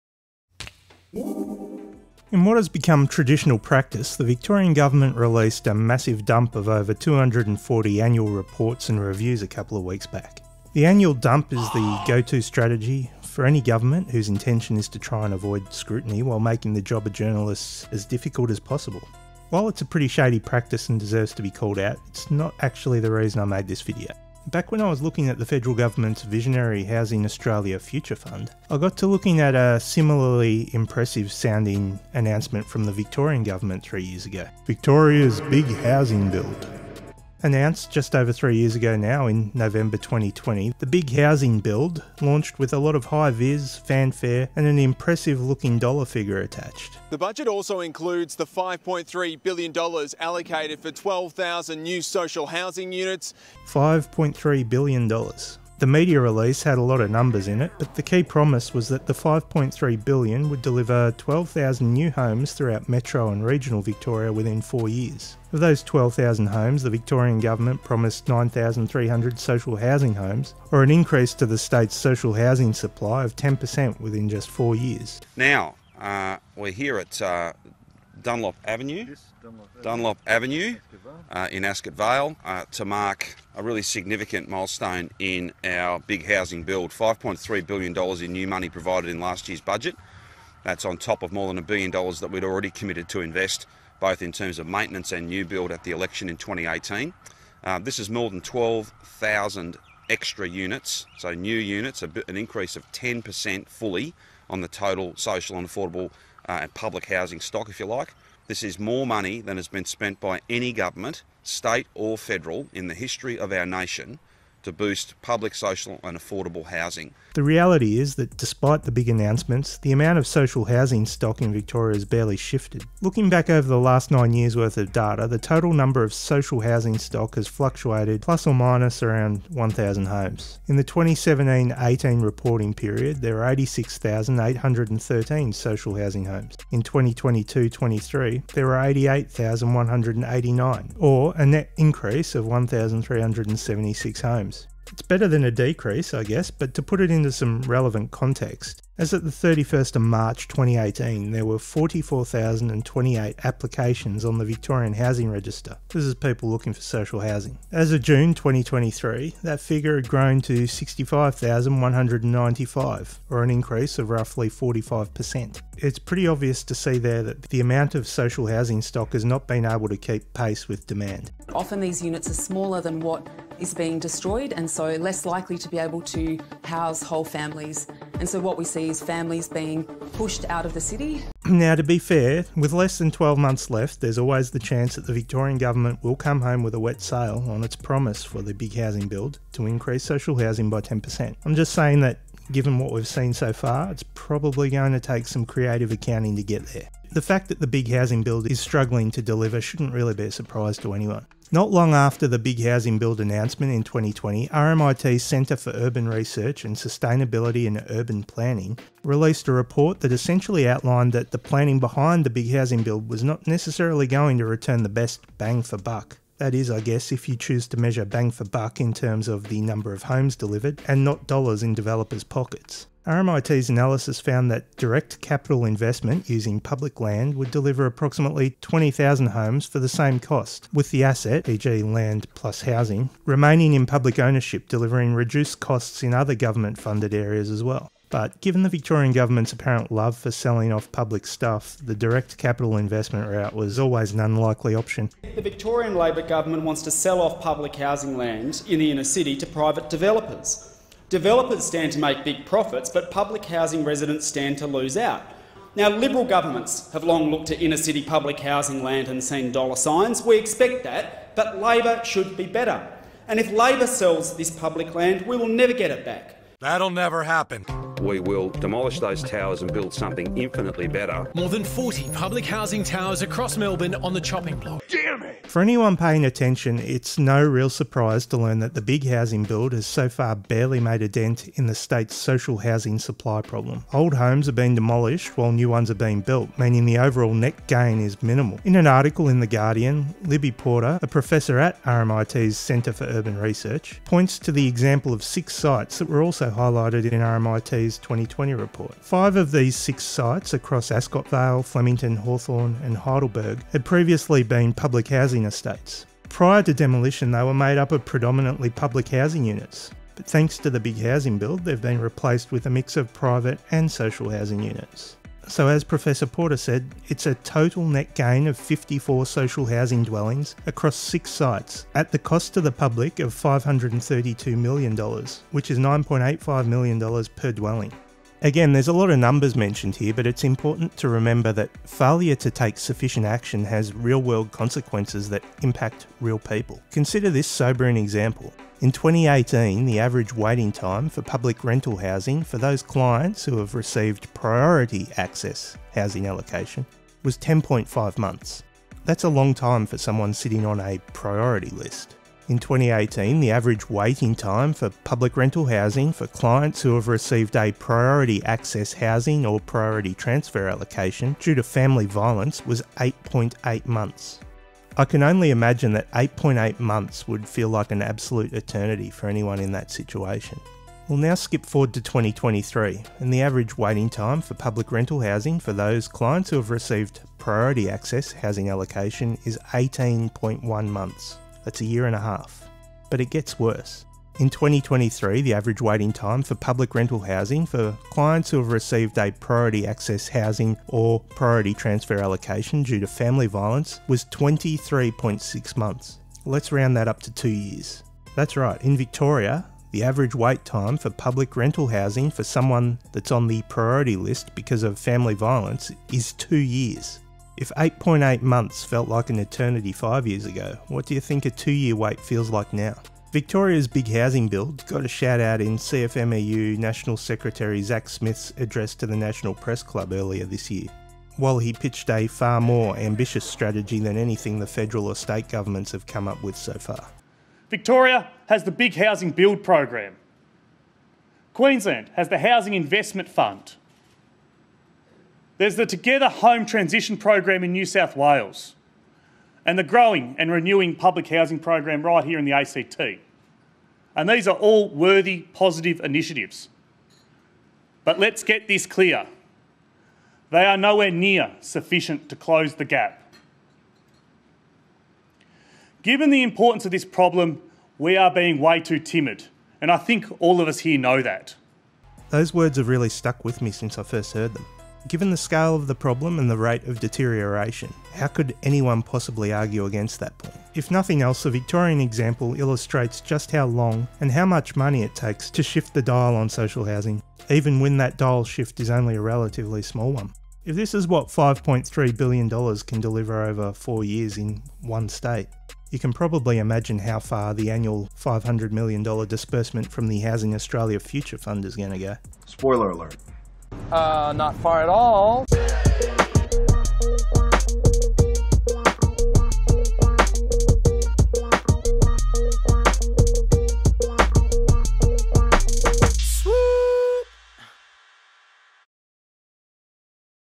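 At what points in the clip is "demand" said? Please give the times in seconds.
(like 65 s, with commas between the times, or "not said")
170 s.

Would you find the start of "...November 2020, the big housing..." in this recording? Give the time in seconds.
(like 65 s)
39 s.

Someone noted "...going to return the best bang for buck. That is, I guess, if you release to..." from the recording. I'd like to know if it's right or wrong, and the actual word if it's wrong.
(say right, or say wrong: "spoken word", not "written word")
wrong: "choose", not "release".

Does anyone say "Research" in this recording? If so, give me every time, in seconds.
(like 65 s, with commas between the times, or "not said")
206 s, 293 s.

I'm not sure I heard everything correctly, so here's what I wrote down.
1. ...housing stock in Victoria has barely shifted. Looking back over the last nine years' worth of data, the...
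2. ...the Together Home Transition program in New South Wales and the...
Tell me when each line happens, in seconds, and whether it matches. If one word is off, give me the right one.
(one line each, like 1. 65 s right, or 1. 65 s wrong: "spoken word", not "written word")
1. 120 s right
2. 435 s right.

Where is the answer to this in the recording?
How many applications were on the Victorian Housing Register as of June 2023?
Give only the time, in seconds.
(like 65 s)
160 s.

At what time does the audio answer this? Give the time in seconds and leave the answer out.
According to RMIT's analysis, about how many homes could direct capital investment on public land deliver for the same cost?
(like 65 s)
228 s.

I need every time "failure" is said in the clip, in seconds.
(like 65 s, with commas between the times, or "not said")
331 s.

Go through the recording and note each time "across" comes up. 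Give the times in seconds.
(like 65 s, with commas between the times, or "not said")
273 s, 300 s, 320 s.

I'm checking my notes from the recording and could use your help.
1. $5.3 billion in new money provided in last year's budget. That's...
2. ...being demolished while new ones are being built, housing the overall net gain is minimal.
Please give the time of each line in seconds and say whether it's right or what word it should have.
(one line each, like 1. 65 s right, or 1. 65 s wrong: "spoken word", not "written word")
1. 86 s right
2. 284 s wrong: "meaning", not "housing".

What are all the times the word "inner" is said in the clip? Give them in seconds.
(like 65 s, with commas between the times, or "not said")
248 s, 257 s.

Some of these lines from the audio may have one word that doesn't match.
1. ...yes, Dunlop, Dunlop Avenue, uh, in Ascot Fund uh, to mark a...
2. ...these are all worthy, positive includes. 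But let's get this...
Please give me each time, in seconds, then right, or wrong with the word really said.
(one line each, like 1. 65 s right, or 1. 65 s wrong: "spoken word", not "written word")
1. 79 s wrong: "Vale", not "Fund"
2. 444 s wrong: "initiatives", not "includes".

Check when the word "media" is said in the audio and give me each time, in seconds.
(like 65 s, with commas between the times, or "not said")
55 s.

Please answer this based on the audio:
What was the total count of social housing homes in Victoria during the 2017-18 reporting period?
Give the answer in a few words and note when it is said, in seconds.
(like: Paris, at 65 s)
86,813, at 133 s.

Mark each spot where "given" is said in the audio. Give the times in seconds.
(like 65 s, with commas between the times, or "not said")
192 s, 238 s, 456 s, 465 s.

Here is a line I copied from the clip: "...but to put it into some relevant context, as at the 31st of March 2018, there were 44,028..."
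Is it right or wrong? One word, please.
right.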